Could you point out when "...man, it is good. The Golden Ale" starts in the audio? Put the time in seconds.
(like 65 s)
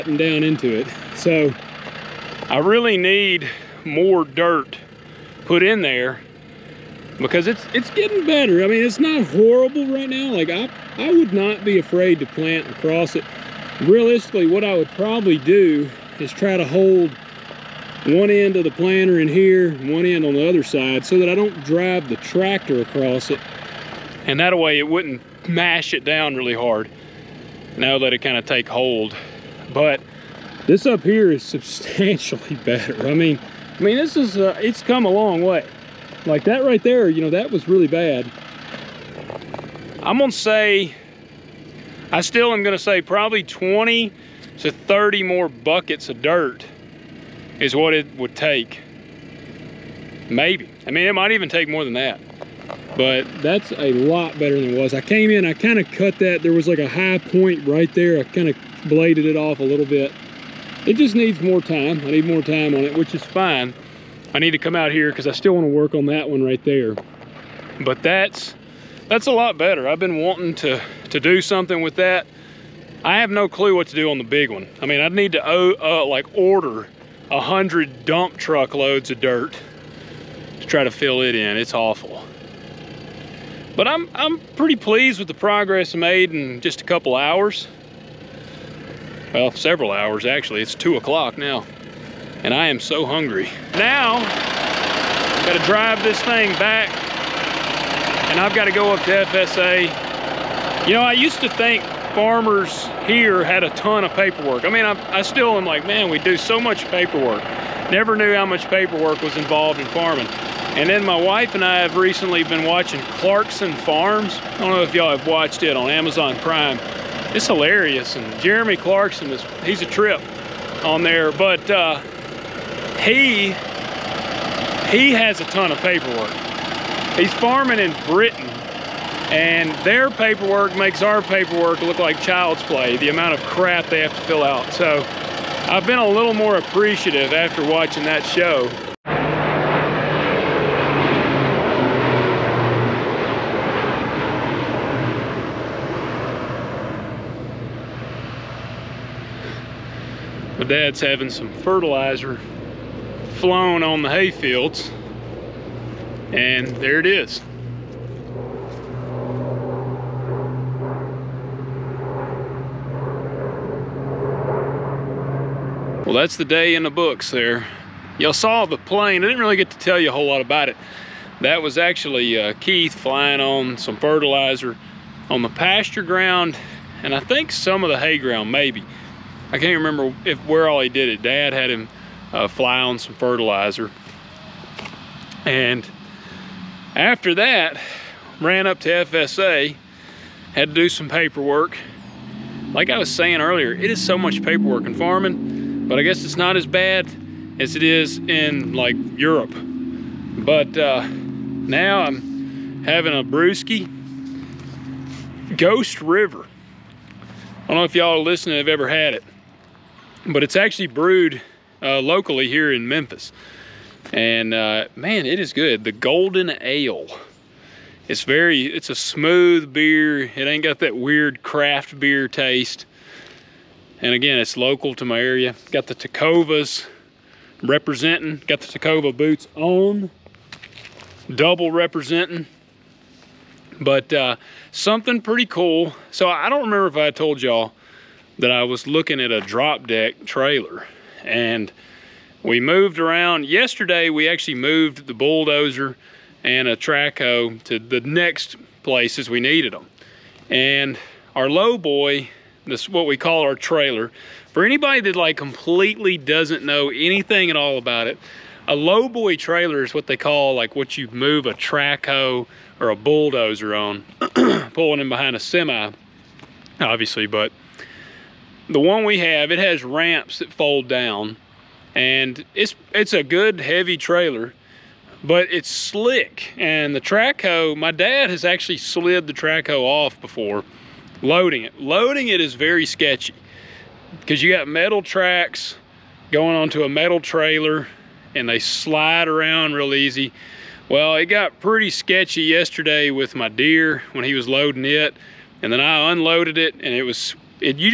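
214 s.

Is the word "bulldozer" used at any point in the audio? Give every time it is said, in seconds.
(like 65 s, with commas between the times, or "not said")
245 s, 262 s.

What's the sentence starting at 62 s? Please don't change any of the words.
I need more time on it, which is fine.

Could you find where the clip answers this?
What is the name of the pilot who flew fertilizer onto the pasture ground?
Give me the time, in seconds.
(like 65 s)
172 s.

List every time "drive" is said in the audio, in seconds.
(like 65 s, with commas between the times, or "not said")
21 s, 95 s.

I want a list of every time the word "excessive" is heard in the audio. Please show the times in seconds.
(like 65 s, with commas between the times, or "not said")
not said.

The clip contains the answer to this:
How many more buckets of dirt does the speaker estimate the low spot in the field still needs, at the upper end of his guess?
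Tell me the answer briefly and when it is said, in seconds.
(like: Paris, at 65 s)
30, at 44 s.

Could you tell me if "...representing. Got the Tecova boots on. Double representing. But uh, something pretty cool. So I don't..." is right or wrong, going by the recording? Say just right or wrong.
right.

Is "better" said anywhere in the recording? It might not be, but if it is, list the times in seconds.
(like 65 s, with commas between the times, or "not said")
8 s, 32 s, 54 s, 69 s.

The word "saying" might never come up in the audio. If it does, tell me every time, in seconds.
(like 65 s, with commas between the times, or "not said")
193 s.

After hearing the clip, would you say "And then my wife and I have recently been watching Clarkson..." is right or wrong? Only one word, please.
right.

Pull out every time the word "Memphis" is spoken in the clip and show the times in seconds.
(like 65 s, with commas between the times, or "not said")
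212 s.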